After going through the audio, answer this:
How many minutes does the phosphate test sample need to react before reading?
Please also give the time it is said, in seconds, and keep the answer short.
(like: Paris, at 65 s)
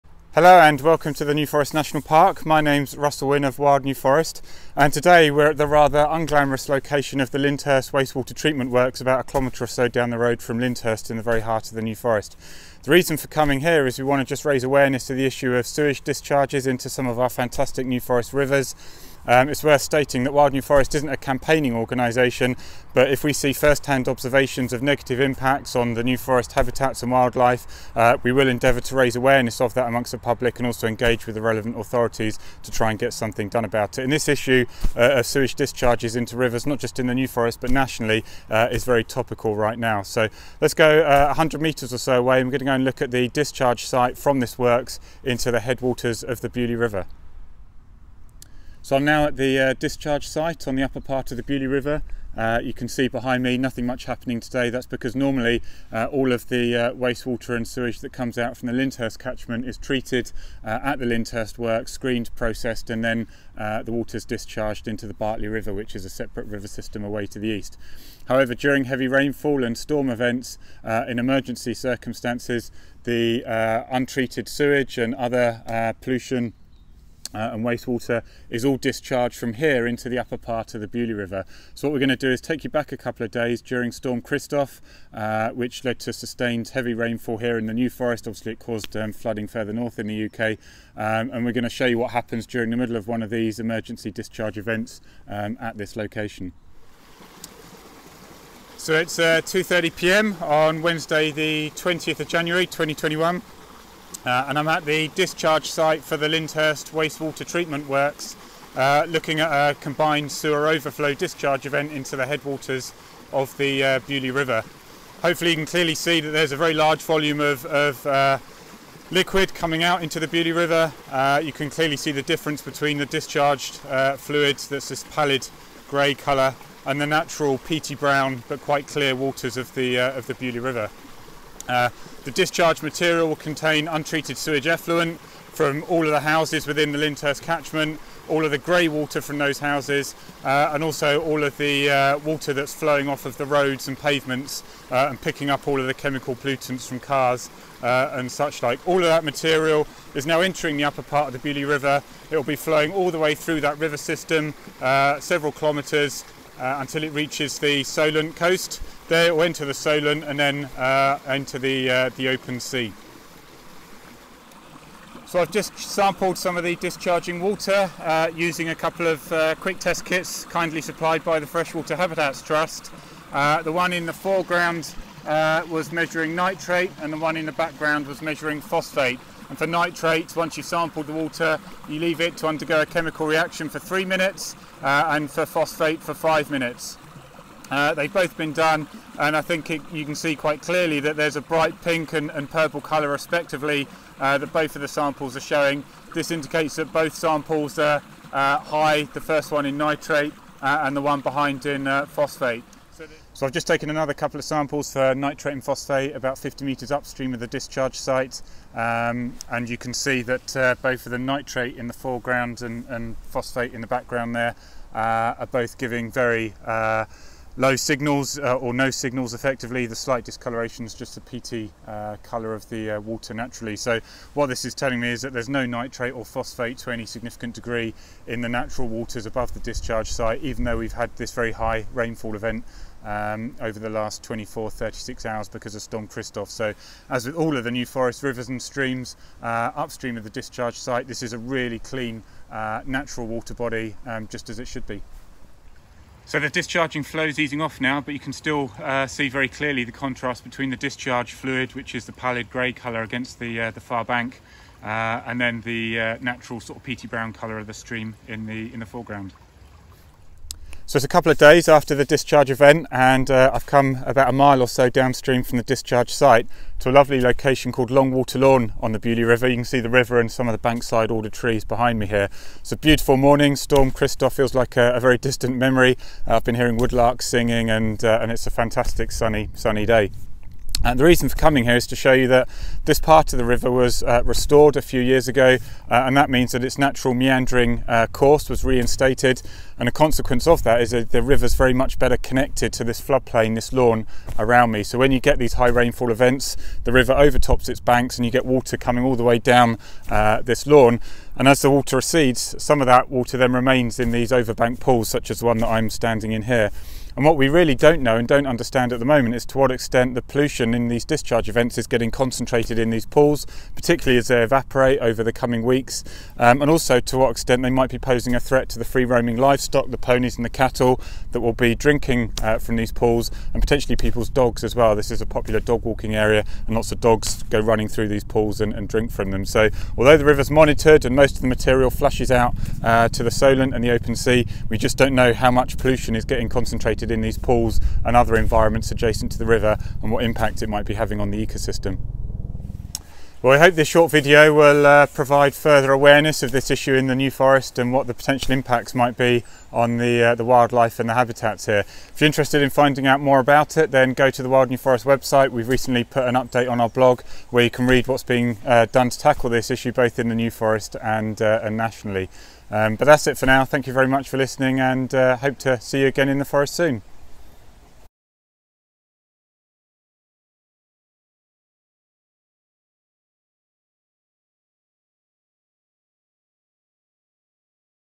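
5, at 186 s.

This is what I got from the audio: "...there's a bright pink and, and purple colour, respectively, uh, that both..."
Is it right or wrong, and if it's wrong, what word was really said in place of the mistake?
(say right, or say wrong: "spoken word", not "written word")
right.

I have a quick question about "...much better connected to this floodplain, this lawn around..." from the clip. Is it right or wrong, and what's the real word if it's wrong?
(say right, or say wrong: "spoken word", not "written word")
right.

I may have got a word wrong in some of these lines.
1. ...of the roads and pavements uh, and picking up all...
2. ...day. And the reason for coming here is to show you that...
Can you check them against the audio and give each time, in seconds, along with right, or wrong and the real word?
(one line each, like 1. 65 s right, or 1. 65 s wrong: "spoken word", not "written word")
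1. 143 s right
2. 279 s right.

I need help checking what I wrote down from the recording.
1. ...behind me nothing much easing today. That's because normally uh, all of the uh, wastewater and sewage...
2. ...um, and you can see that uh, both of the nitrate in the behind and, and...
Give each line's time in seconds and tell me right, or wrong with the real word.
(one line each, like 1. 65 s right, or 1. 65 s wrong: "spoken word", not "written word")
1. 53 s wrong: "happening", not "easing"
2. 208 s wrong: "foreground", not "behind".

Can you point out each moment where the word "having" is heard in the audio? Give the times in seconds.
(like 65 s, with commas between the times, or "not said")
340 s.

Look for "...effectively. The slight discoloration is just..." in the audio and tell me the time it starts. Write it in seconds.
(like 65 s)
219 s.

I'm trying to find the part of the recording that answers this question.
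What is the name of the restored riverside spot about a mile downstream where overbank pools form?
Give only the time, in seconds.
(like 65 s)
267 s.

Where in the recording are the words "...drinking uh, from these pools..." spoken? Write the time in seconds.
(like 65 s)
321 s.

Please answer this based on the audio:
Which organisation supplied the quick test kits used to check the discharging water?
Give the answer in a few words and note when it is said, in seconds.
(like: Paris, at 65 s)
Freshwater Habitats Trust, at 171 s.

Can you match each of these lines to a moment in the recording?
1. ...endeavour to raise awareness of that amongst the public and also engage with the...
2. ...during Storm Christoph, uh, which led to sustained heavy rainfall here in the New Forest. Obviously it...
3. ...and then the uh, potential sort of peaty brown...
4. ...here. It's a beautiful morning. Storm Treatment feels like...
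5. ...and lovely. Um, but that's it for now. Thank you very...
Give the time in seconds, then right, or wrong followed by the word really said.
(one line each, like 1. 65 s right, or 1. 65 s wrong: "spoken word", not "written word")
1. 28 s right
2. 83 s right
3. 255 s wrong: "natural", not "potential"
4. 272 s wrong: "Christoph", not "Treatment"
5. 361 s wrong: "nationally", not "lovely".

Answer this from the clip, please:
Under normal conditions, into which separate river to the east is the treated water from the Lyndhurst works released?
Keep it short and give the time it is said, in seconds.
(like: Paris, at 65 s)
Bartley River, at 65 s.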